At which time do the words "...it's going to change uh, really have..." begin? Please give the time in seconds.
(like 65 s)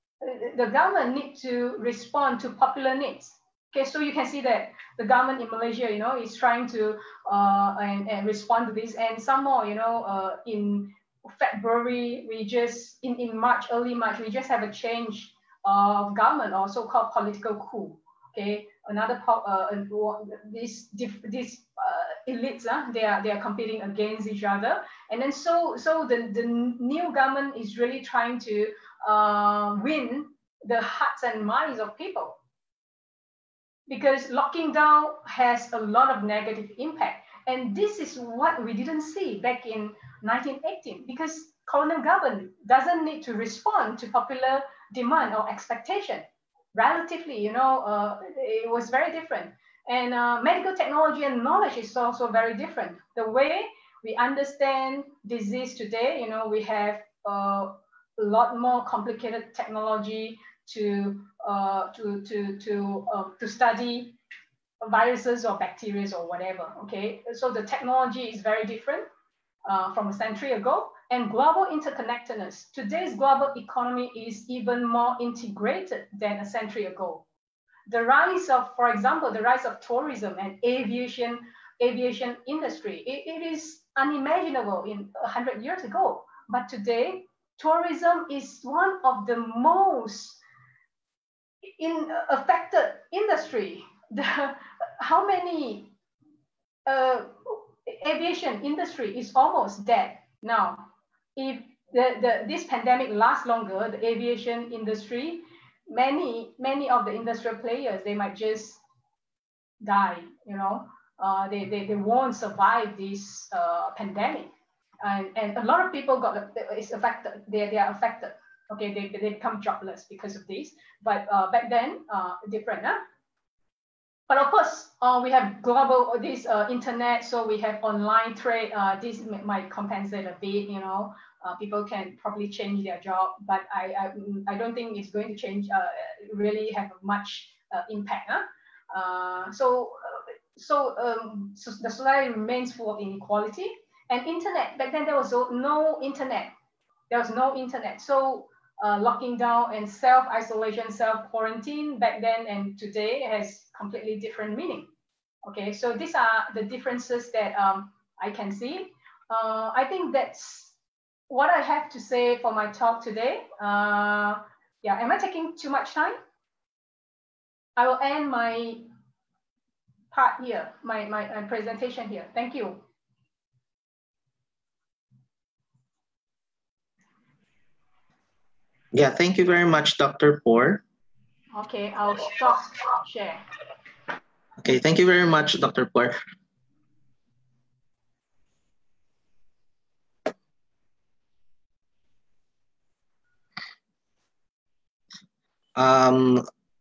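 134 s.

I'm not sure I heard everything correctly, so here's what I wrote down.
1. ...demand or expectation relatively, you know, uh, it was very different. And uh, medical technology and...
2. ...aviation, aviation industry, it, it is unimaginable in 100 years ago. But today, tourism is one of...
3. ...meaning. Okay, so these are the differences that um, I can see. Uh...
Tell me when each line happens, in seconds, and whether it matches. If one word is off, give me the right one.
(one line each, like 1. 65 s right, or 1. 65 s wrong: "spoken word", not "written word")
1. 44 s right
2. 80 s right
3. 154 s right.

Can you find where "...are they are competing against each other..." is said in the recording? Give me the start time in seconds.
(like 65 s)
23 s.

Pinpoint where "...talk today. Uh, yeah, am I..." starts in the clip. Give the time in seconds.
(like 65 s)
162 s.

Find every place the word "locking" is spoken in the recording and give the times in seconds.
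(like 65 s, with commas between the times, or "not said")
34 s, 148 s.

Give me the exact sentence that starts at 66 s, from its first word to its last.
Okay, so the technology is very different uh, from a century ago and global interconnectedness.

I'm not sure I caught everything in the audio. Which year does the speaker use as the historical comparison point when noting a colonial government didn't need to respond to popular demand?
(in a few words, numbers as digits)
1918.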